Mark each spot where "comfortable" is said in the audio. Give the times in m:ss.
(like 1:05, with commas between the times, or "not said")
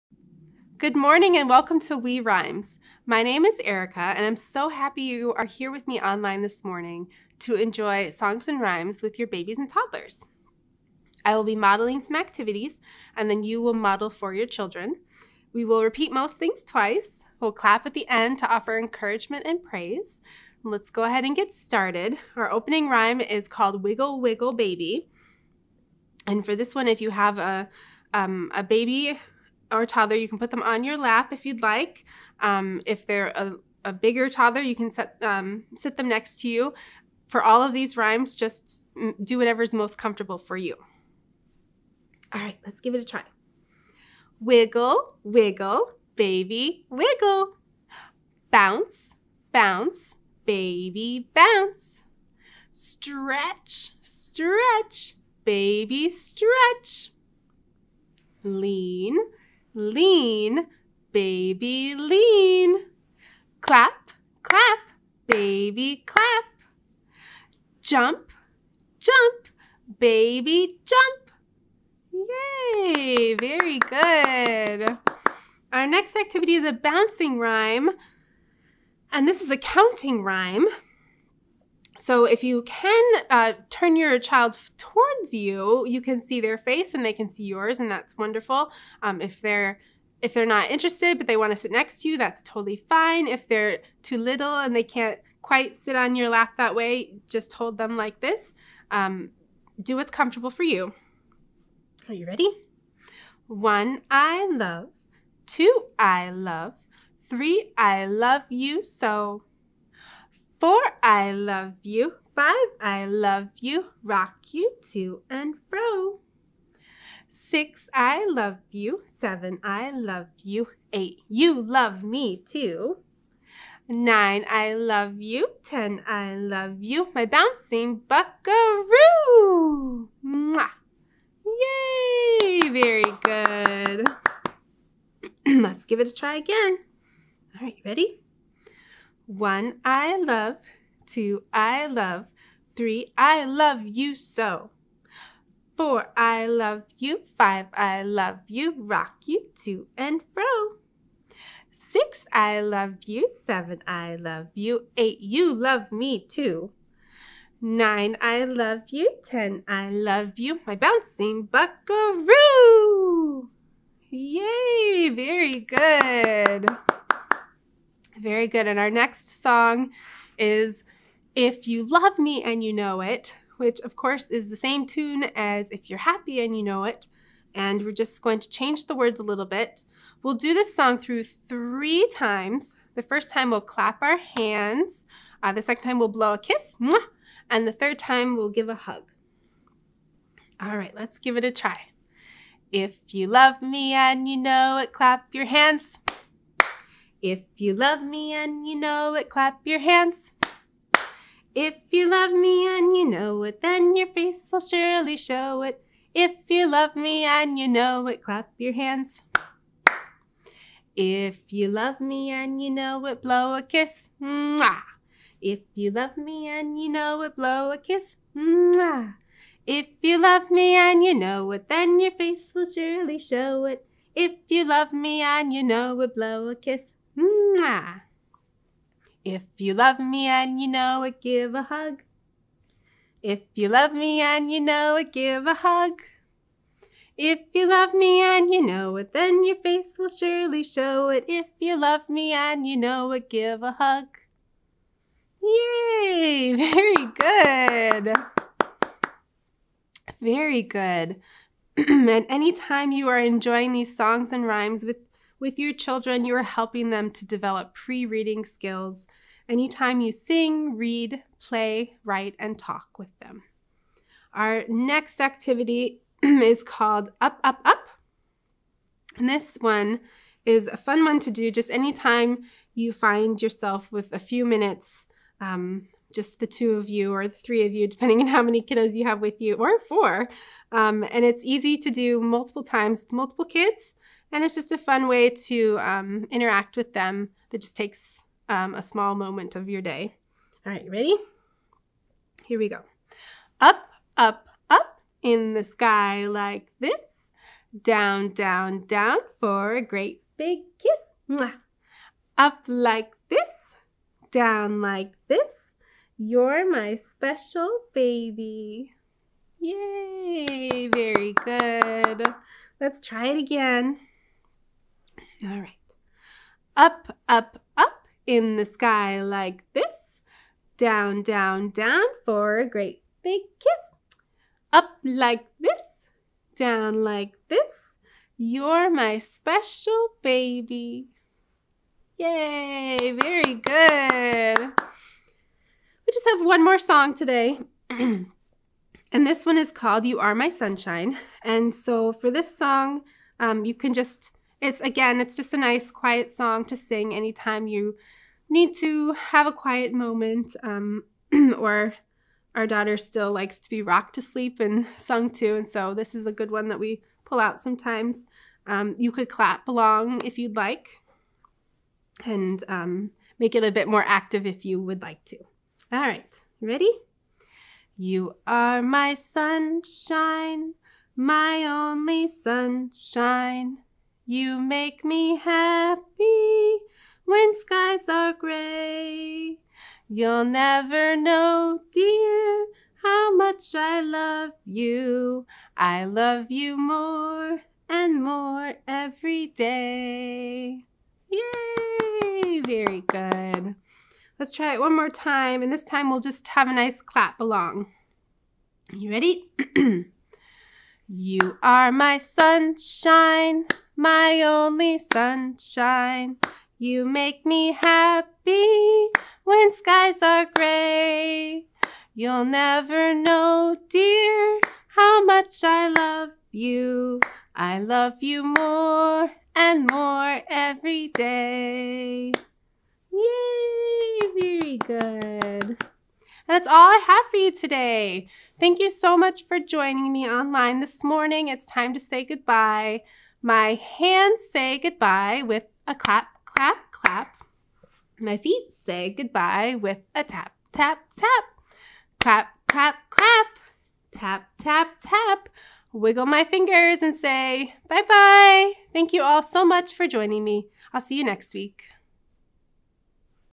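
0:39, 1:40.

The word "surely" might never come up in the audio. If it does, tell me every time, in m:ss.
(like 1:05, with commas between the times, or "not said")
3:24, 3:42, 4:00.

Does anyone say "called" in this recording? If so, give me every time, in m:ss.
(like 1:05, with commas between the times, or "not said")
0:23, 4:26, 5:39.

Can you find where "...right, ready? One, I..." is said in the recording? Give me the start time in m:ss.
2:17.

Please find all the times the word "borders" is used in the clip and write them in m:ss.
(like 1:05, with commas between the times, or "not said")
not said.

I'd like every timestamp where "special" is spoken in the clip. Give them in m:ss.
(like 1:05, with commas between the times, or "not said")
5:06, 5:29.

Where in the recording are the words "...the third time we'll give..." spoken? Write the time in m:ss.
3:07.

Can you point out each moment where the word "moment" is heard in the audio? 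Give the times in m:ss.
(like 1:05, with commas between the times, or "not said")
4:49, 5:49.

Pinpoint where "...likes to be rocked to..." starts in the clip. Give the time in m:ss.
5:53.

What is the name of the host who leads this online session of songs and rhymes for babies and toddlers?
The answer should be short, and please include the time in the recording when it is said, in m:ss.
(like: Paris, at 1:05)
Erika, at 0:03.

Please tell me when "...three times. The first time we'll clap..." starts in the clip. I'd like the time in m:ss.
3:01.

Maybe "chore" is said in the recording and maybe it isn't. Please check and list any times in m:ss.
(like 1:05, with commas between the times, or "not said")
not said.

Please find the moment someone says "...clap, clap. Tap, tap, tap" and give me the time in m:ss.
7:22.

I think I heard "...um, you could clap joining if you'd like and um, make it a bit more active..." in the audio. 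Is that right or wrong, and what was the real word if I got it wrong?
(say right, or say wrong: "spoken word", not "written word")
wrong: "along", not "joining".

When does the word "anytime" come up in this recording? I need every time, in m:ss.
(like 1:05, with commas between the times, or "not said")
4:12, 4:19, 4:31, 5:47.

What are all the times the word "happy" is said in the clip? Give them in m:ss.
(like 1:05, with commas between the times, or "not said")
0:04, 2:55, 6:15, 6:47.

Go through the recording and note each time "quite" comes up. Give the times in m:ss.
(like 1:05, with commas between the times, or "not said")
1:35.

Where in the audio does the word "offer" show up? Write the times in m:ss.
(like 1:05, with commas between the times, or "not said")
0:18.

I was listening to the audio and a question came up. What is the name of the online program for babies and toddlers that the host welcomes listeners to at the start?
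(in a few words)
Wee Rhymes.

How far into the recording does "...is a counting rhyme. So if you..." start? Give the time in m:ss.
1:19.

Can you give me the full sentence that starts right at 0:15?
We will repeat most things twice.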